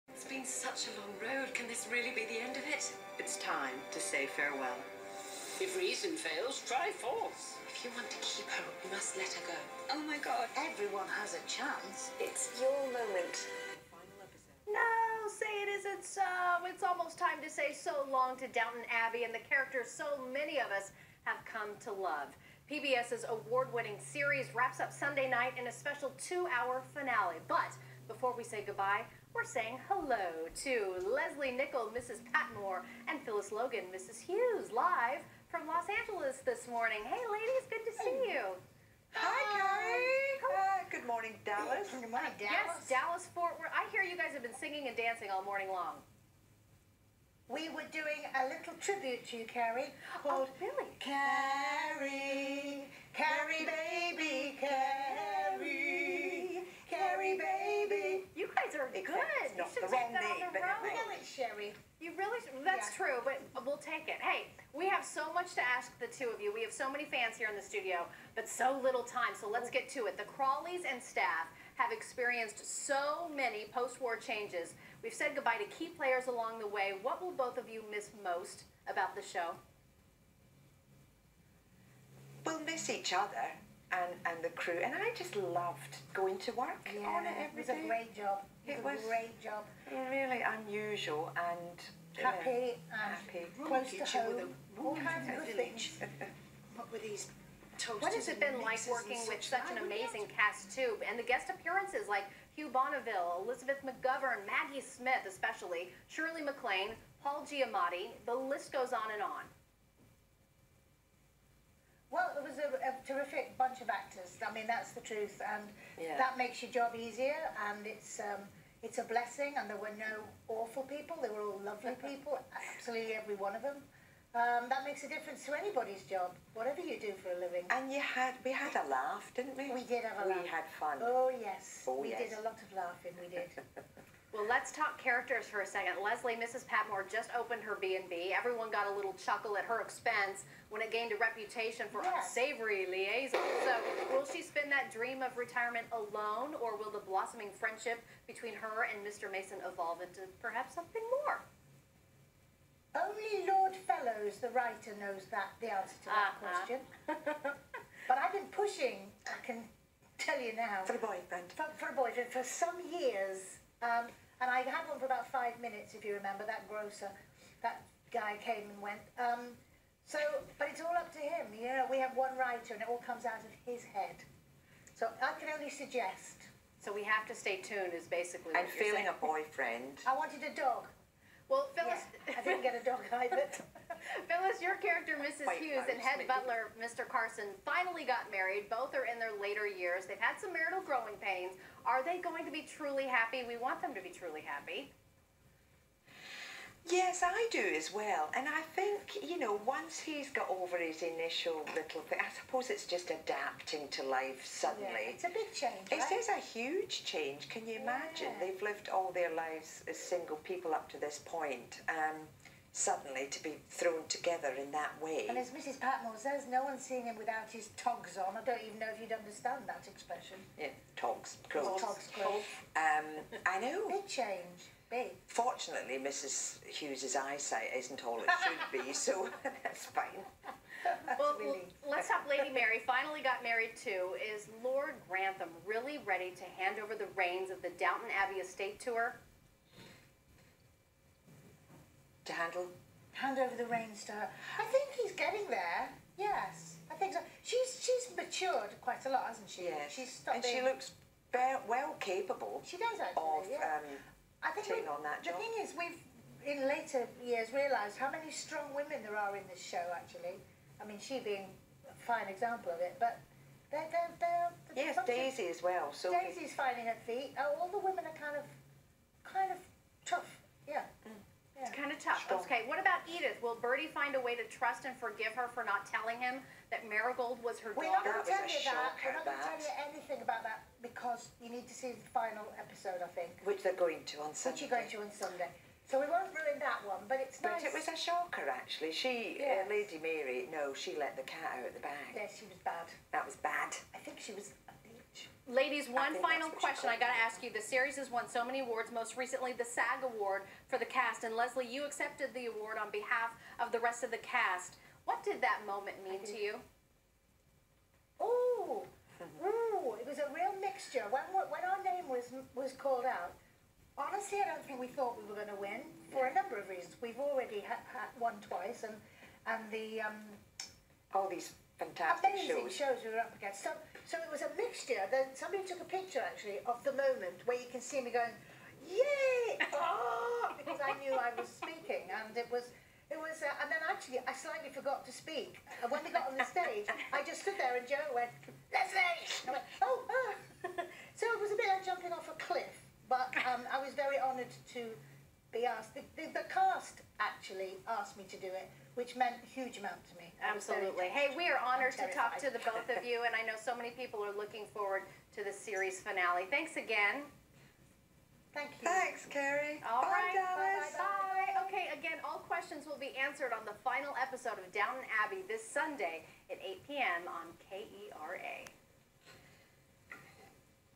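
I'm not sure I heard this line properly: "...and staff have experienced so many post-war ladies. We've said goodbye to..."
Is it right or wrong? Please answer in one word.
wrong.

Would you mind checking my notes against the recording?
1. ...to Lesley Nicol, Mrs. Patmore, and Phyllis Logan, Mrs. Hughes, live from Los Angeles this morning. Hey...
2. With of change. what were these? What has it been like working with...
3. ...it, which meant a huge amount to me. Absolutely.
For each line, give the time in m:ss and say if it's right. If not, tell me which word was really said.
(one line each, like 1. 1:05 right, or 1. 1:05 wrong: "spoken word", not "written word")
1. 0:30 right
2. 1:34 wrong: "village", not "change"
3. 5:48 right.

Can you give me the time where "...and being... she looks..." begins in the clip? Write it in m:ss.
4:10.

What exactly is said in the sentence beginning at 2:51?
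You know, we have one writer, and it all comes out of his head.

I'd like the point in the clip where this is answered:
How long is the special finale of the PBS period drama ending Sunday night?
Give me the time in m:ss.
0:26.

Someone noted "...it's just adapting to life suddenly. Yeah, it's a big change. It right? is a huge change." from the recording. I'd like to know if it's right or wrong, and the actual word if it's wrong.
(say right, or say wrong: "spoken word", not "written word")
right.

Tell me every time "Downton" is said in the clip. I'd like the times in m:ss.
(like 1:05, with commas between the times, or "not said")
0:18, 3:57, 6:04.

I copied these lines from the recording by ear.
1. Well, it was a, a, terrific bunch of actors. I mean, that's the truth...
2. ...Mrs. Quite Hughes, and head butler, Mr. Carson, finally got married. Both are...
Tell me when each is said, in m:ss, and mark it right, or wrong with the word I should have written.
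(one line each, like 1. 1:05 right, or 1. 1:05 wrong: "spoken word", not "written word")
1. 1:52 right
2. 3:05 right.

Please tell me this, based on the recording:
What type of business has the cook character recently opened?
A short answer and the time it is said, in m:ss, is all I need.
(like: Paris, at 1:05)
B&B, at 2:17.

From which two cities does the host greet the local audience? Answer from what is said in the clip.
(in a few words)
Dallas, Fort Worth.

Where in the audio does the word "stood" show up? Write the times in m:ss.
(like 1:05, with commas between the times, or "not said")
5:37.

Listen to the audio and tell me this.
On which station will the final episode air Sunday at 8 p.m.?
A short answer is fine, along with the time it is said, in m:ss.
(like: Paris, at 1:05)
KERA, at 6:07.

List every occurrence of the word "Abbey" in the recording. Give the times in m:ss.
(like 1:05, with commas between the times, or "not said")
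0:18, 3:58, 6:05.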